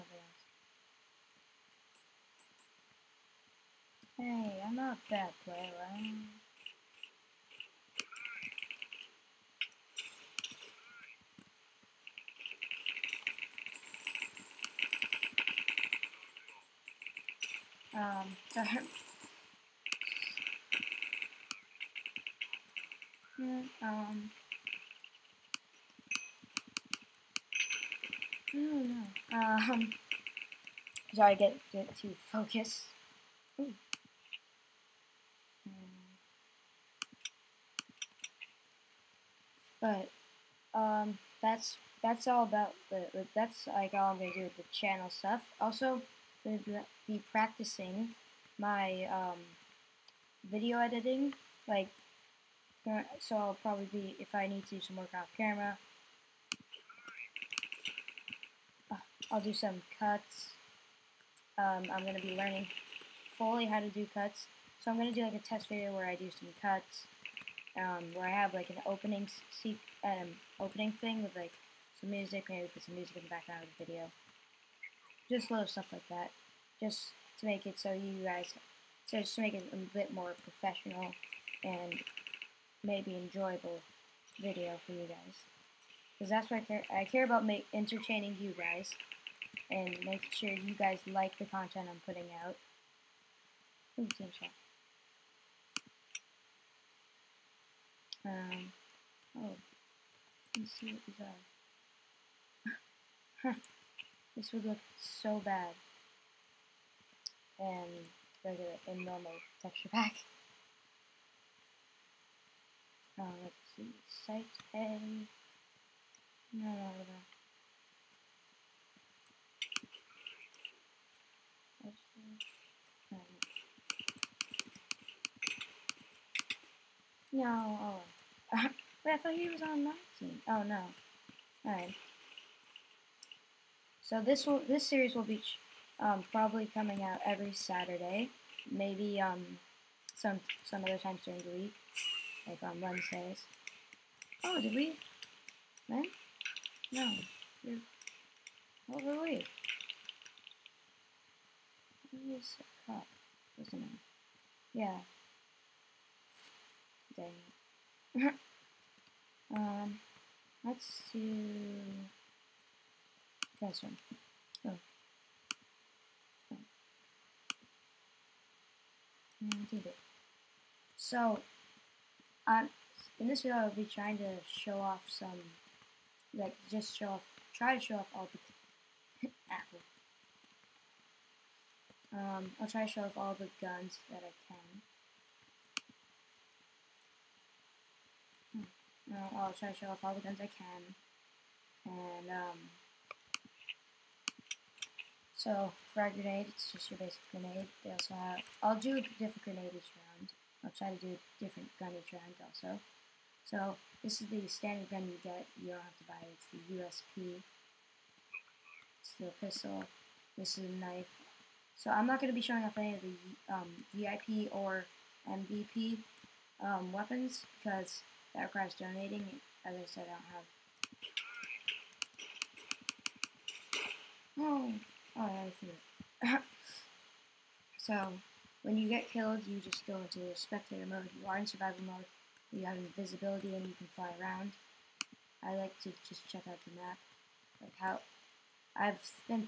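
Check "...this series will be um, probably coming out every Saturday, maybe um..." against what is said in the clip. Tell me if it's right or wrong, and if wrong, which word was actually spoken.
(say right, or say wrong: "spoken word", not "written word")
right.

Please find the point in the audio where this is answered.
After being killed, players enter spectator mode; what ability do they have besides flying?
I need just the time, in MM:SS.
03:52.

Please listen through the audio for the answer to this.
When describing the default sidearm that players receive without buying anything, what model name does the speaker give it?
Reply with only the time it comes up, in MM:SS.
03:27.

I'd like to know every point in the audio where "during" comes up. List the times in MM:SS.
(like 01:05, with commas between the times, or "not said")
02:21.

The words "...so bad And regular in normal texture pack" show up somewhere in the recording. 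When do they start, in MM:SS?
01:45.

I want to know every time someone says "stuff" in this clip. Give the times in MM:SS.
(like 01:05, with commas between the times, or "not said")
00:45, 01:15.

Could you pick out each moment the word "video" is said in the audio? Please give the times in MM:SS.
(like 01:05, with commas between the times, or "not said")
00:50, 01:05, 01:13, 01:24, 02:53.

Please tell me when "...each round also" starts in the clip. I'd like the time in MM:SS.
03:21.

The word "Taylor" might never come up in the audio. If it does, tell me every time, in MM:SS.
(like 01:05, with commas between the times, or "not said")
not said.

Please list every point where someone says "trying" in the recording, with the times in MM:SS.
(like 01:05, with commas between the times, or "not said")
02:53.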